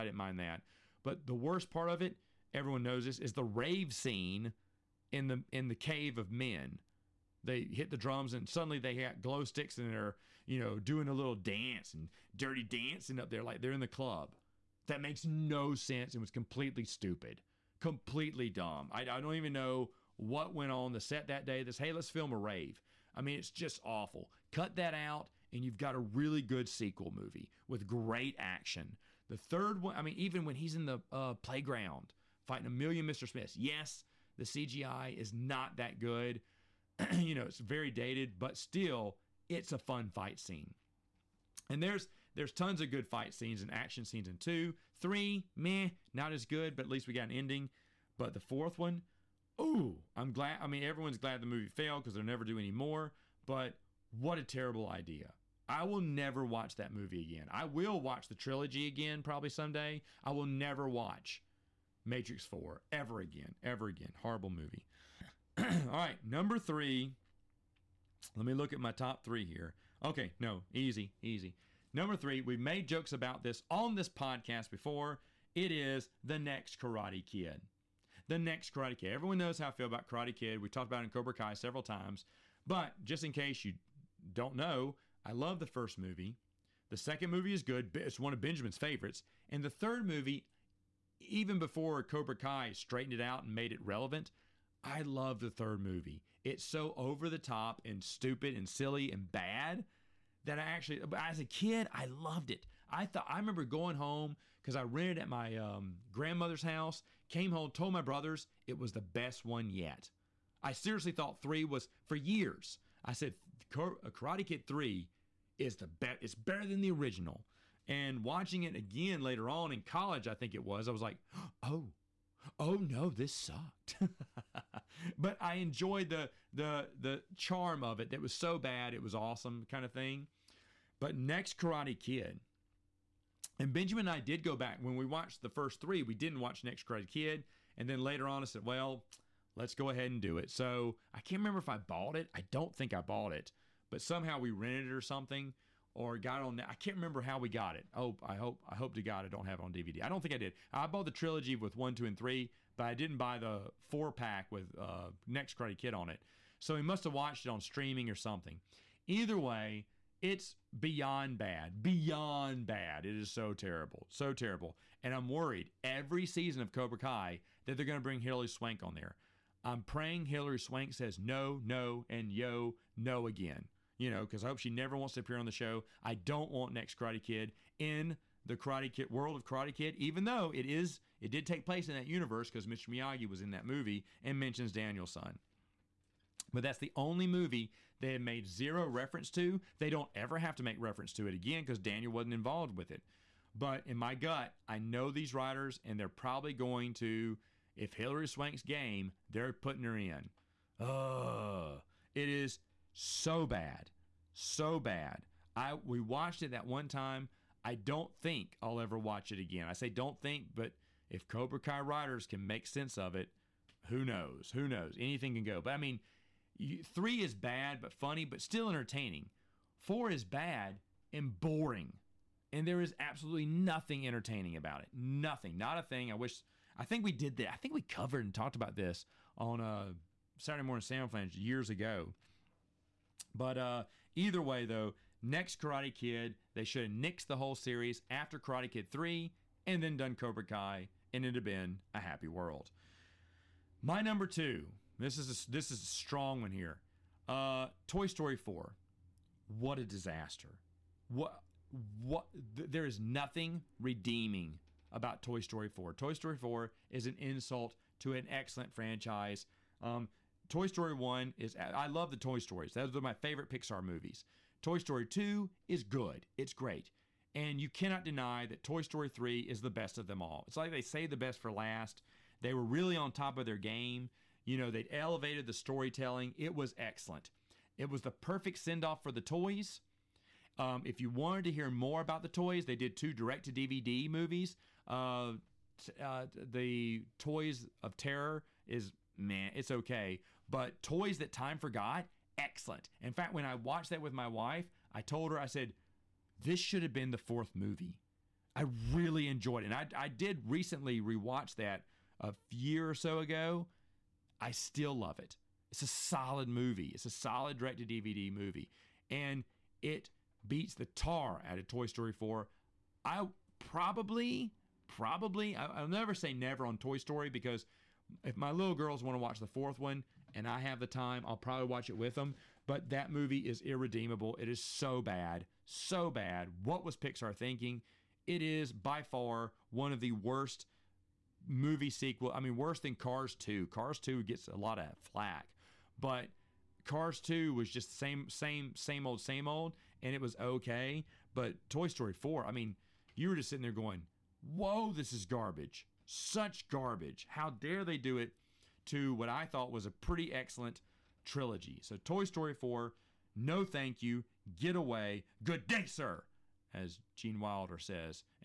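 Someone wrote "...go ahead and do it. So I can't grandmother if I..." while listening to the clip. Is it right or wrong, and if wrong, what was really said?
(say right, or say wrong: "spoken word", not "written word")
wrong: "remember", not "grandmother".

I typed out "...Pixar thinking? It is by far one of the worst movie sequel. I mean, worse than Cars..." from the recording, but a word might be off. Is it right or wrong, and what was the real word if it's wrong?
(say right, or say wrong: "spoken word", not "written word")
right.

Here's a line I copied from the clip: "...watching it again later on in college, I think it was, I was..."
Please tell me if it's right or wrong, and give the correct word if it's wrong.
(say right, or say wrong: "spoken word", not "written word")
right.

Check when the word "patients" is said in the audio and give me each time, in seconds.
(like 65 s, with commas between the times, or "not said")
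not said.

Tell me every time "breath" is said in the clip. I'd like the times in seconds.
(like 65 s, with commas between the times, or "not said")
not said.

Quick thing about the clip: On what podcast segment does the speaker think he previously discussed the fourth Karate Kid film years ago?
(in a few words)
Saturday morning Samoflange.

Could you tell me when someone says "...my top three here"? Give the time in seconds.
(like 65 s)
68 s.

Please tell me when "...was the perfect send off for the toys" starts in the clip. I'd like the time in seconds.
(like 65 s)
277 s.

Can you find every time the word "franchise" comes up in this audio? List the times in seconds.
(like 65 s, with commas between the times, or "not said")
258 s.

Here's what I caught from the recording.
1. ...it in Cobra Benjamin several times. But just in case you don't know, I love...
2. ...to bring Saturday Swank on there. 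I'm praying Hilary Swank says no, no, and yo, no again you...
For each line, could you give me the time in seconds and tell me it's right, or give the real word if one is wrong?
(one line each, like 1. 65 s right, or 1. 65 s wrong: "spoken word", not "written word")
1. 81 s wrong: "Kai", not "Benjamin"
2. 167 s wrong: "Hilary", not "Saturday".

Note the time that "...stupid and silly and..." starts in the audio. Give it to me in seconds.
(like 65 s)
98 s.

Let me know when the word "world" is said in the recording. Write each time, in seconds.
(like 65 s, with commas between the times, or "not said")
179 s, 242 s.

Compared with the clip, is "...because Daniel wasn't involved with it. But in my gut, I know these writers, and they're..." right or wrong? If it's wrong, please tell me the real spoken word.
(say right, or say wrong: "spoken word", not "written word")
right.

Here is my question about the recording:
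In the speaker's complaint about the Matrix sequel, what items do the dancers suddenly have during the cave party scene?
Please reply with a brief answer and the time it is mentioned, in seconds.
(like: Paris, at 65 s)
glow sticks, at 9 s.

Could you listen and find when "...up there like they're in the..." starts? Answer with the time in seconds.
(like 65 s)
13 s.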